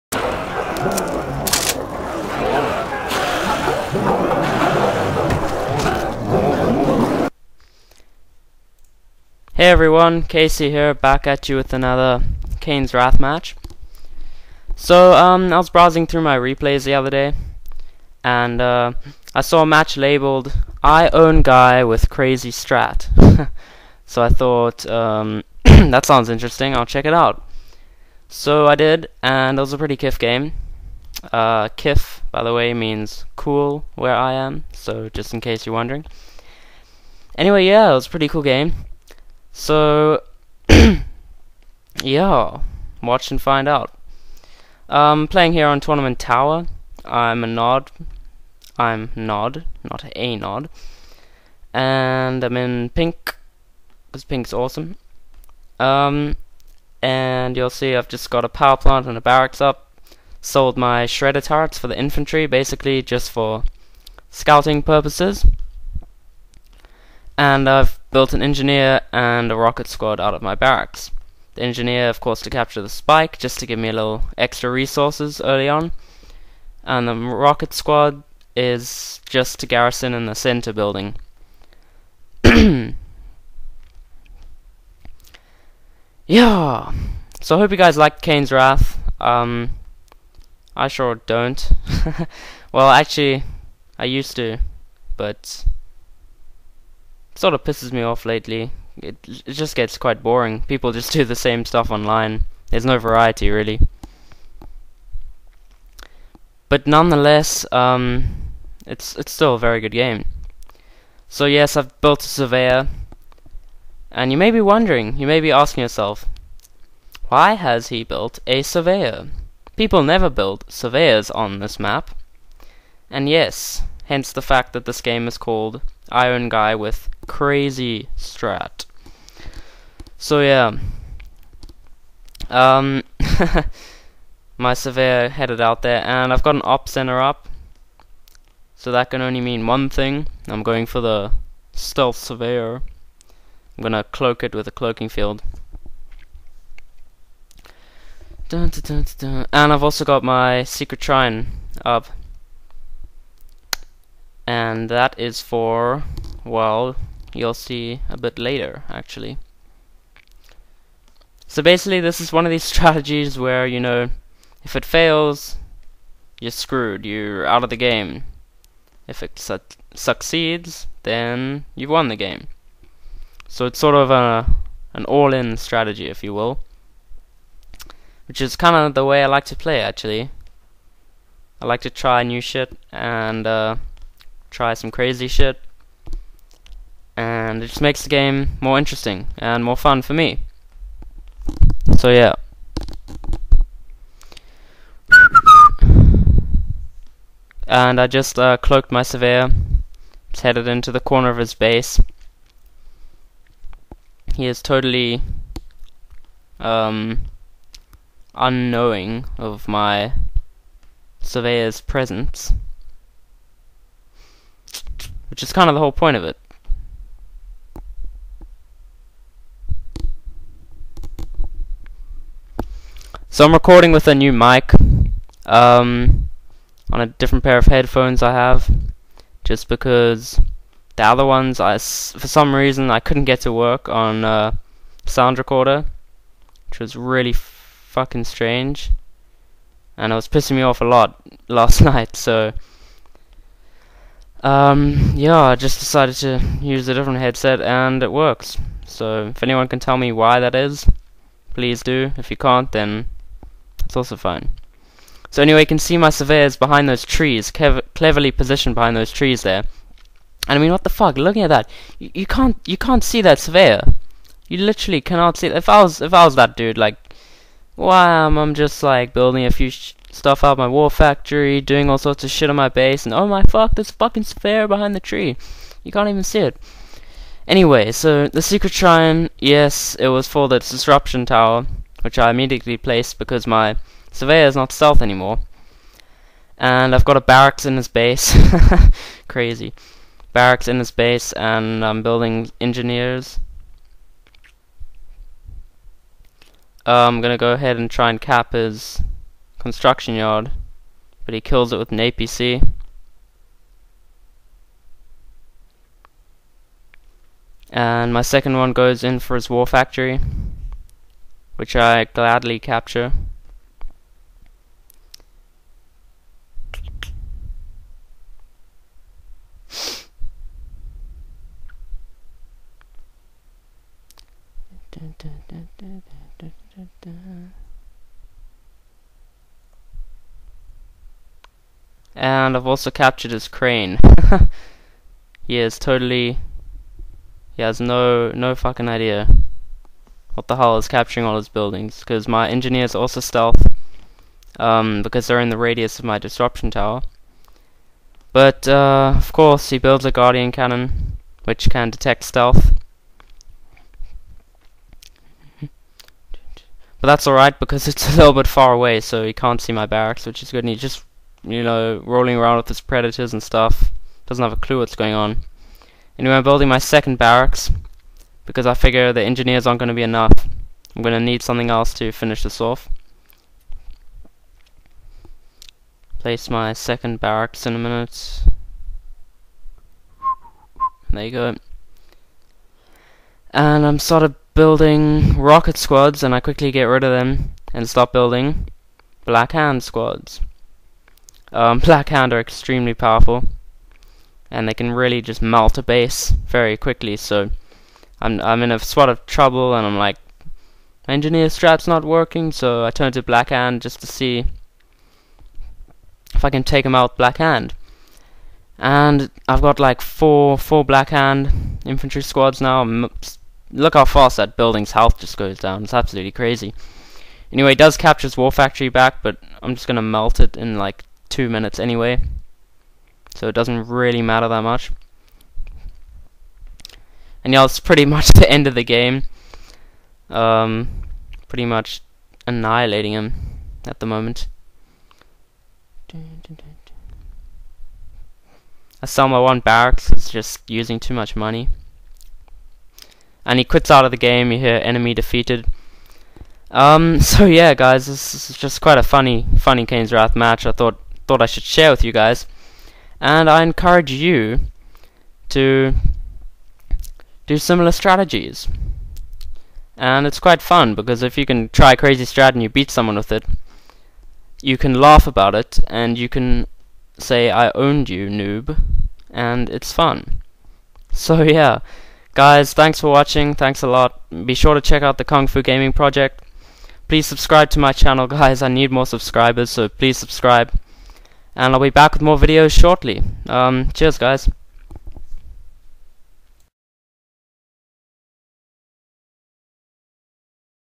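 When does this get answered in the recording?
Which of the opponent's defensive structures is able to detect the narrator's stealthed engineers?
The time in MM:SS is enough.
05:50.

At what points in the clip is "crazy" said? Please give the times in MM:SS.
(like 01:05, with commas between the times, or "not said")
00:22, 02:07, 03:04, 04:49, 06:56, 07:41.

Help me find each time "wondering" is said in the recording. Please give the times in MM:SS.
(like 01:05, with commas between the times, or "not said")
00:35, 01:54.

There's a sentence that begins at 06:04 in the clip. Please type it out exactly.
Doesn't have a clue what's going on.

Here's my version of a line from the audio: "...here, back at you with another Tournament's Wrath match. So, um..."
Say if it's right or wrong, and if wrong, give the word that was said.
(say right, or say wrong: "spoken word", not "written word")
wrong: "Kane", not "Tournament".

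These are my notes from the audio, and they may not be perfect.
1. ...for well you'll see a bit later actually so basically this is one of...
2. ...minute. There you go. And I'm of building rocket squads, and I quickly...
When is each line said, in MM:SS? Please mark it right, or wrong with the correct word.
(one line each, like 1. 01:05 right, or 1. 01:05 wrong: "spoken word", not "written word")
1. 02:35 right
2. 06:17 right.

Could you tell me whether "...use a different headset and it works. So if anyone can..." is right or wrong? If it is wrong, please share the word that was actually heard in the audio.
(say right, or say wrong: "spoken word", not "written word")
right.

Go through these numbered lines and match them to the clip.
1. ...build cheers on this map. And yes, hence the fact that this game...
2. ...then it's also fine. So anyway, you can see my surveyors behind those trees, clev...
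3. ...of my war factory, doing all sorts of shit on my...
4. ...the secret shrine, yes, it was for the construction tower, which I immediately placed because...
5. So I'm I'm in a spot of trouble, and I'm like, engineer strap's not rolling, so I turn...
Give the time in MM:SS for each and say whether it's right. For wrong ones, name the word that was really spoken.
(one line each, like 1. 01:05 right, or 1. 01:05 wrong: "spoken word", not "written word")
1. 02:00 wrong: "surveyors", not "cheers"
2. 04:12 right
3. 04:30 right
4. 04:38 wrong: "disruption", not "construction"
5. 06:37 wrong: "working", not "rolling".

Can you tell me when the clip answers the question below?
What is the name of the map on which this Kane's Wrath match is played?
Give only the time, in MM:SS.
00:45.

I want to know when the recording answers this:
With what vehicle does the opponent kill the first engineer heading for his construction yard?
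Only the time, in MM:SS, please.
05:01.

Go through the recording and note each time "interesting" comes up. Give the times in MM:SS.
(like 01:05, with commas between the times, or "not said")
00:26, 03:08.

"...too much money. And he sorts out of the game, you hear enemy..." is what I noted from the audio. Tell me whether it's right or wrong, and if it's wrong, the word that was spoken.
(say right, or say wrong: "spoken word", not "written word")
wrong: "quits", not "sorts".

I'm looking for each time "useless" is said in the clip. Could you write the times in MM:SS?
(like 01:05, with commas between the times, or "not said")
not said.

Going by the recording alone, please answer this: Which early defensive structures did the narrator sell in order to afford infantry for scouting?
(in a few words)
Shredder turrets.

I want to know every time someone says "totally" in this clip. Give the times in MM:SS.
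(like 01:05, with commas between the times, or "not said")
03:24, 05:35.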